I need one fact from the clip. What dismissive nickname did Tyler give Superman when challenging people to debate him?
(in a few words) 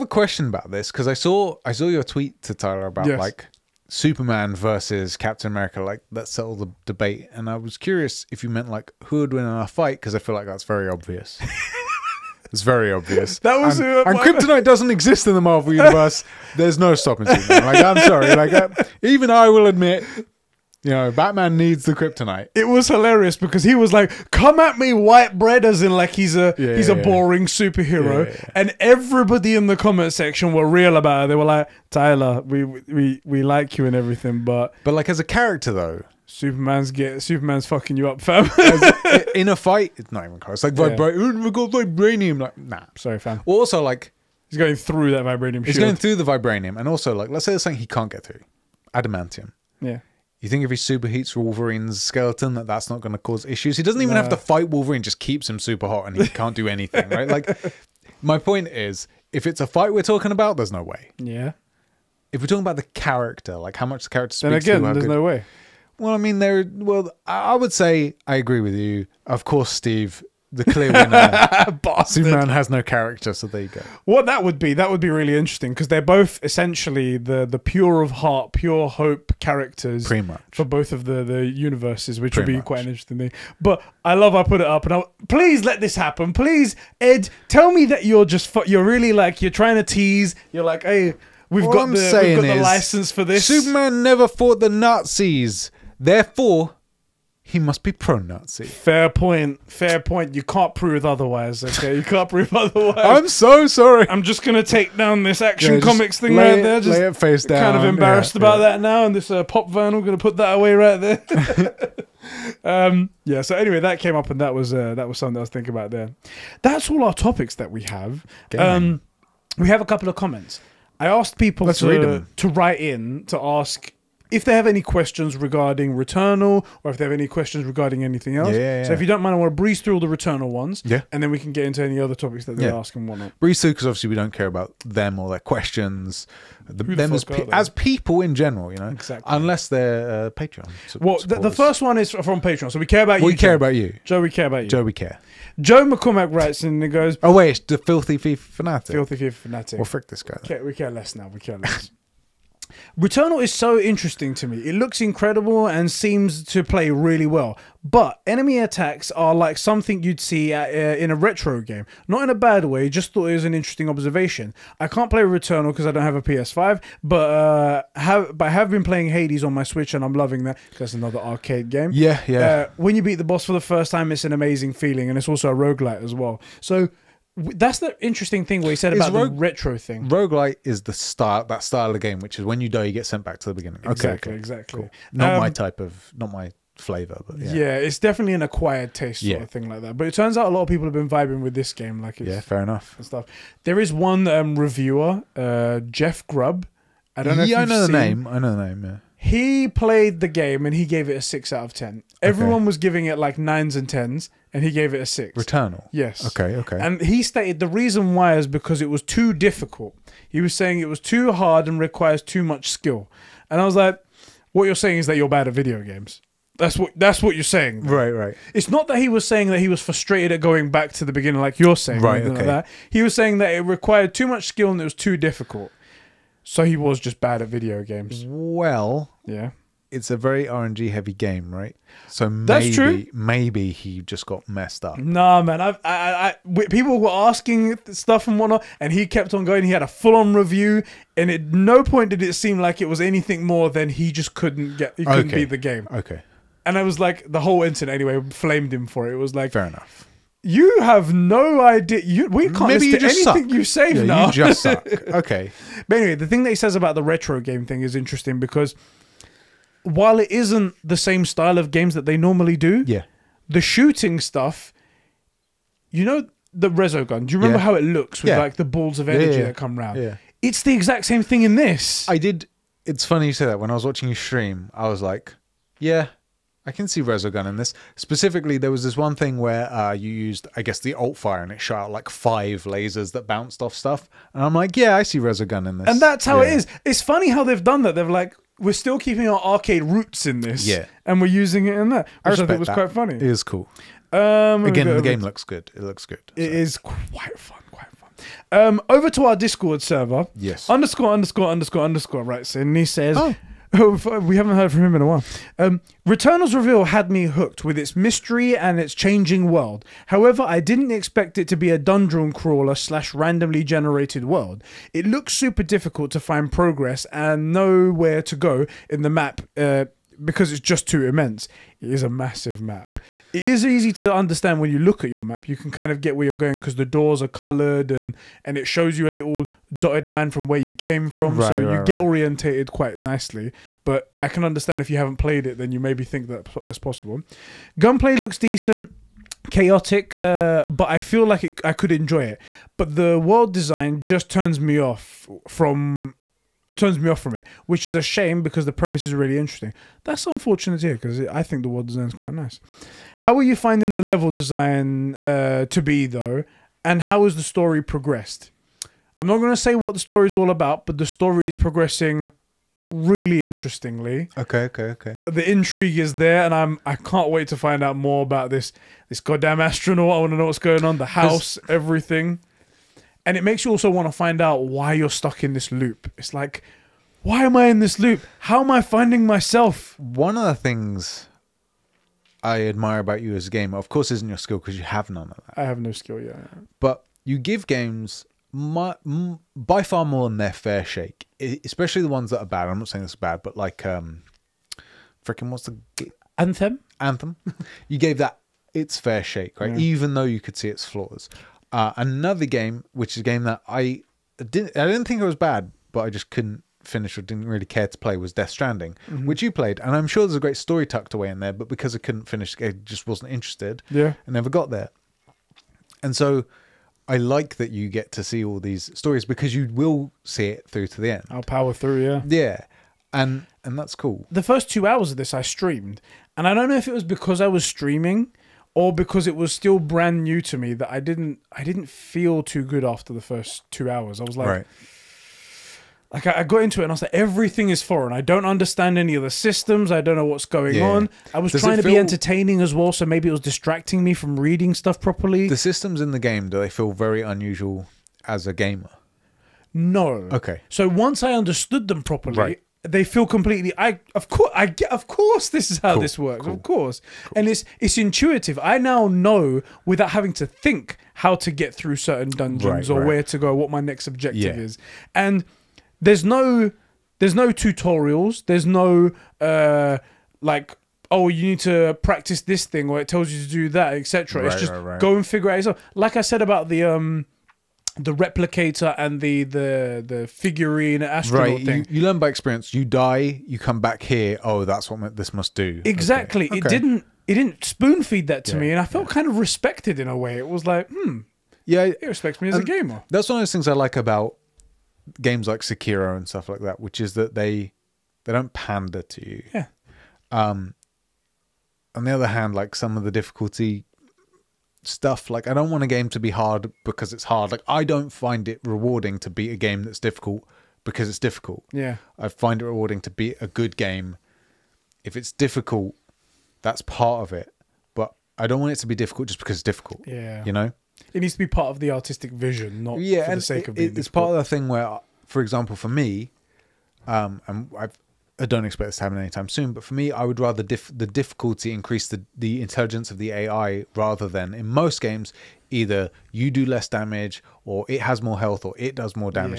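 white bread.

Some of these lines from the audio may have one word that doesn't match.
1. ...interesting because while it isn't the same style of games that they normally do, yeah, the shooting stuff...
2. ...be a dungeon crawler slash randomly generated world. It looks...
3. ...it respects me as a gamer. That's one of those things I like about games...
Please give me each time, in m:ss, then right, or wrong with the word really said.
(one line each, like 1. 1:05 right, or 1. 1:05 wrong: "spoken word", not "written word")
1. 4:17 right
2. 5:11 right
3. 8:11 right.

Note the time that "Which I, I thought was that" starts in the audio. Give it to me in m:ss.
4:52.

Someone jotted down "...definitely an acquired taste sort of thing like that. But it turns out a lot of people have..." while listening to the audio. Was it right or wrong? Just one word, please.
right.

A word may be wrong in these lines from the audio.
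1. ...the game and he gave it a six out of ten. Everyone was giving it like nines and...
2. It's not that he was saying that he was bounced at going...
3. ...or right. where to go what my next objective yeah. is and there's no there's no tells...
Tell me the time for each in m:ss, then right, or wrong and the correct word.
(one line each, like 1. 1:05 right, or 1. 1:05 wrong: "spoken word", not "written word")
1. 3:20 right
2. 3:38 wrong: "frustrated", not "bounced"
3. 7:42 wrong: "tutorials", not "tells".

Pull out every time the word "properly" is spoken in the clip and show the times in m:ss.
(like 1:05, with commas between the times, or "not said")
7:24, 7:32.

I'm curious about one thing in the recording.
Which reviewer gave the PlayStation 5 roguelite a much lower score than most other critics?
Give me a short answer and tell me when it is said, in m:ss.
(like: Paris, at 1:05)
Jeff Grubb, at 3:15.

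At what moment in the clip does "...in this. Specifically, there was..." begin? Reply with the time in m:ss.
4:37.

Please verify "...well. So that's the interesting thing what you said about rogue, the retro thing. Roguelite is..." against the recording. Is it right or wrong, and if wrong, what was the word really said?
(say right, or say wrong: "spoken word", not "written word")
right.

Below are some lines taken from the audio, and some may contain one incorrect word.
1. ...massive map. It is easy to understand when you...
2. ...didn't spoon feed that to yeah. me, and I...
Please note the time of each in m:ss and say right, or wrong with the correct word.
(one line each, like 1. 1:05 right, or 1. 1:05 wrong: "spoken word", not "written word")
1. 5:22 right
2. 8:07 right.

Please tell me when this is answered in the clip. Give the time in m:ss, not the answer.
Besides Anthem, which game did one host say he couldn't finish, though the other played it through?
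6:48.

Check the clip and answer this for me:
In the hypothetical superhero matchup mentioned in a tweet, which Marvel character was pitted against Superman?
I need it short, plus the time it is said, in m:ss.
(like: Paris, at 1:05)
Captain America, at 0:05.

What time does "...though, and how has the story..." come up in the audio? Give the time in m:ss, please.
5:56.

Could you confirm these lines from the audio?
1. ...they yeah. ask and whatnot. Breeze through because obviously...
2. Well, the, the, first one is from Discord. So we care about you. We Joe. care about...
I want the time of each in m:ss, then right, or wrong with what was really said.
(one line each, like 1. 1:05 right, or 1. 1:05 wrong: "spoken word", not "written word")
1. 2:12 right
2. 2:20 wrong: "Patreon", not "Discord".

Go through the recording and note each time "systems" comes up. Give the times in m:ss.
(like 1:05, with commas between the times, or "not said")
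7:19, 7:25.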